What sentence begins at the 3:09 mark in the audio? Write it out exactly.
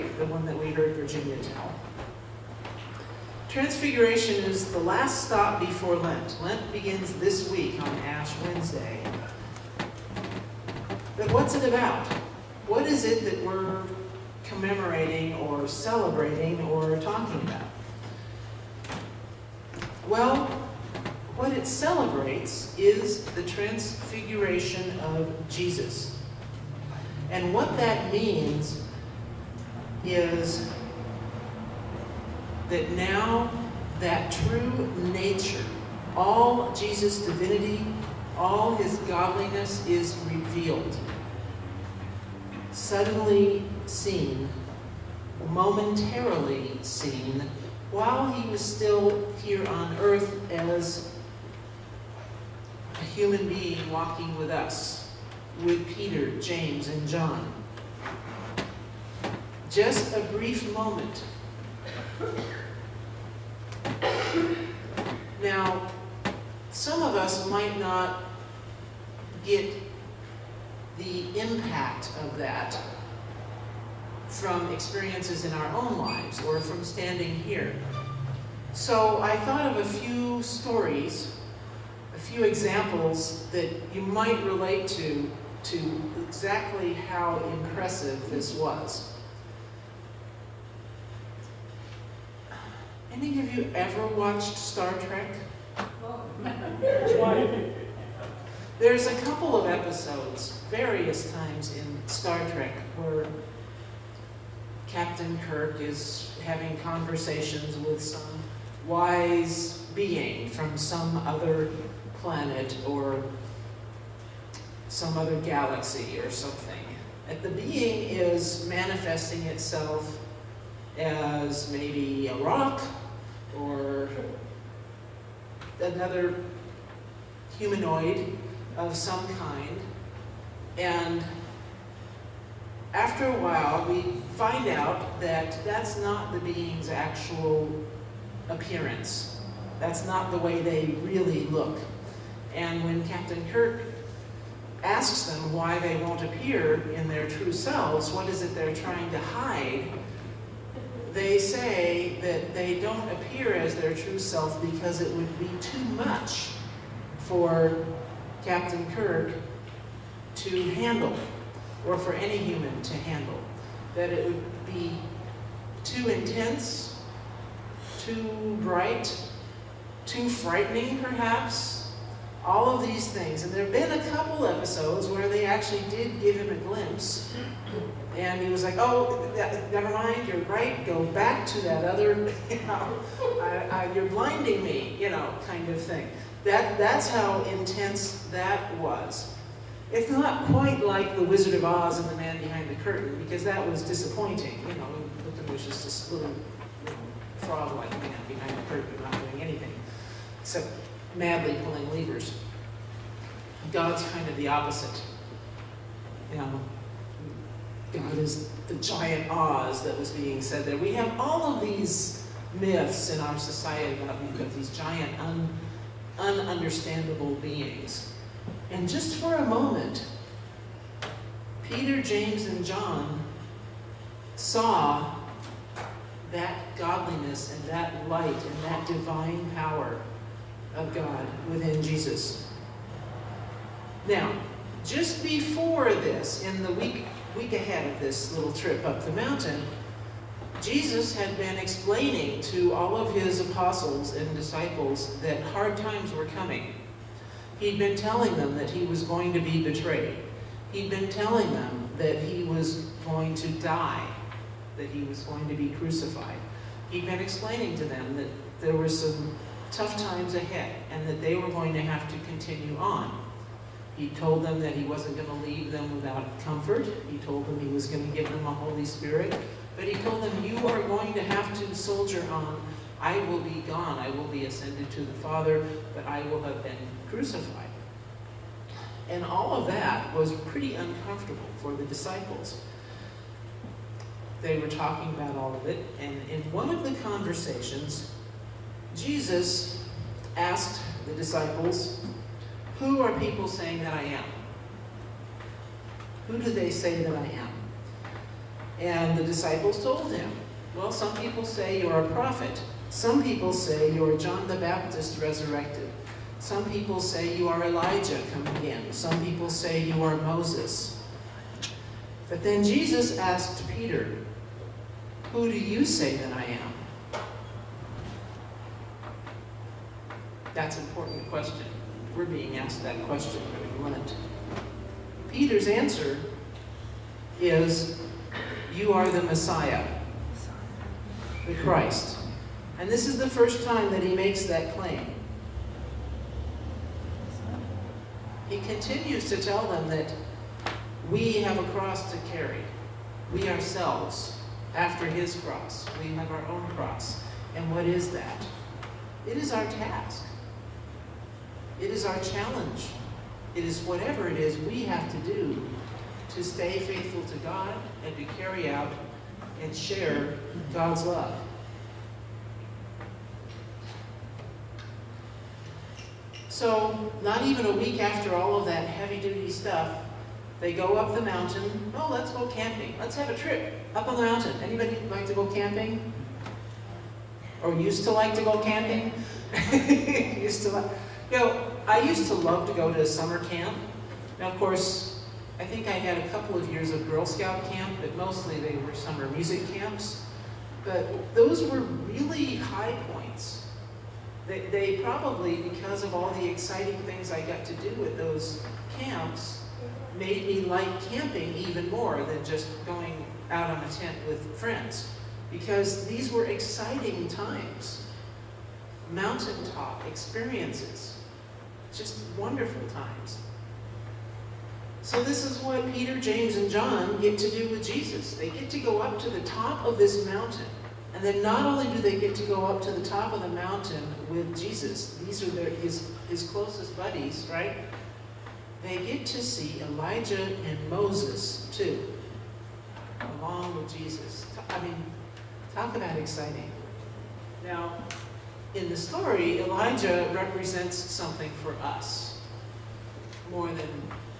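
It's not quite like The Wizard of Oz and The Man Behind the Curtain, because that was disappointing.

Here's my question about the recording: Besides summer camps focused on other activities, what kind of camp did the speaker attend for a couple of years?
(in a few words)
Girl Scout camp.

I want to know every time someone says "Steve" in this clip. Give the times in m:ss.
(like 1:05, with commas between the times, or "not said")
not said.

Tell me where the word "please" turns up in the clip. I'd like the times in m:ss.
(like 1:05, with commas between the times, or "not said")
not said.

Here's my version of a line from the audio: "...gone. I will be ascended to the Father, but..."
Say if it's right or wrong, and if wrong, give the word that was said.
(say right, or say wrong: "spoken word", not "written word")
right.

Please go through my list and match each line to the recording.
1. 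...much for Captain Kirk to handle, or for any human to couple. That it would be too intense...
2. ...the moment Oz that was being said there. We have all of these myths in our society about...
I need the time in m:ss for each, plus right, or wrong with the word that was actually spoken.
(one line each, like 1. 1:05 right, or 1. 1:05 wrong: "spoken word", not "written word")
1. 2:35 wrong: "handle", not "couple"
2. 3:28 wrong: "giant", not "moment".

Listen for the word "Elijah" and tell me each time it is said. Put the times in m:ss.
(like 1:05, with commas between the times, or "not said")
5:07, 7:09, 7:19.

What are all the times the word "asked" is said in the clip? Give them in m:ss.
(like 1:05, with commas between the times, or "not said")
4:50, 5:13, 5:22.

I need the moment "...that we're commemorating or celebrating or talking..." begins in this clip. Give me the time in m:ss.
0:13.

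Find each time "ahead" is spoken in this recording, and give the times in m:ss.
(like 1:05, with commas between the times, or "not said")
3:57, 4:20.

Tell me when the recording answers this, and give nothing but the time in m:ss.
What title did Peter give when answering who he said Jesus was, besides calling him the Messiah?
5:31.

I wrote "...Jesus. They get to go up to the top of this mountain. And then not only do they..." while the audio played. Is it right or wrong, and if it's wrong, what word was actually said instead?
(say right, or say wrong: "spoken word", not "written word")
right.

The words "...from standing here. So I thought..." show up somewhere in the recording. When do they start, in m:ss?
1:16.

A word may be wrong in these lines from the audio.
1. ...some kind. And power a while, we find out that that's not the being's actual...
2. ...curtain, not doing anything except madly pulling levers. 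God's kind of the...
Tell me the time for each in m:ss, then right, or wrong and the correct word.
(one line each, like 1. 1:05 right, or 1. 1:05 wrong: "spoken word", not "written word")
1. 2:08 wrong: "after", not "power"
2. 3:18 right.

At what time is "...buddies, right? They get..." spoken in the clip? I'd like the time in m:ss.
7:06.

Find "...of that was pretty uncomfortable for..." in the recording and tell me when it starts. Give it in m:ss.
4:39.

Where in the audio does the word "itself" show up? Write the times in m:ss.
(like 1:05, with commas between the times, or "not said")
1:59.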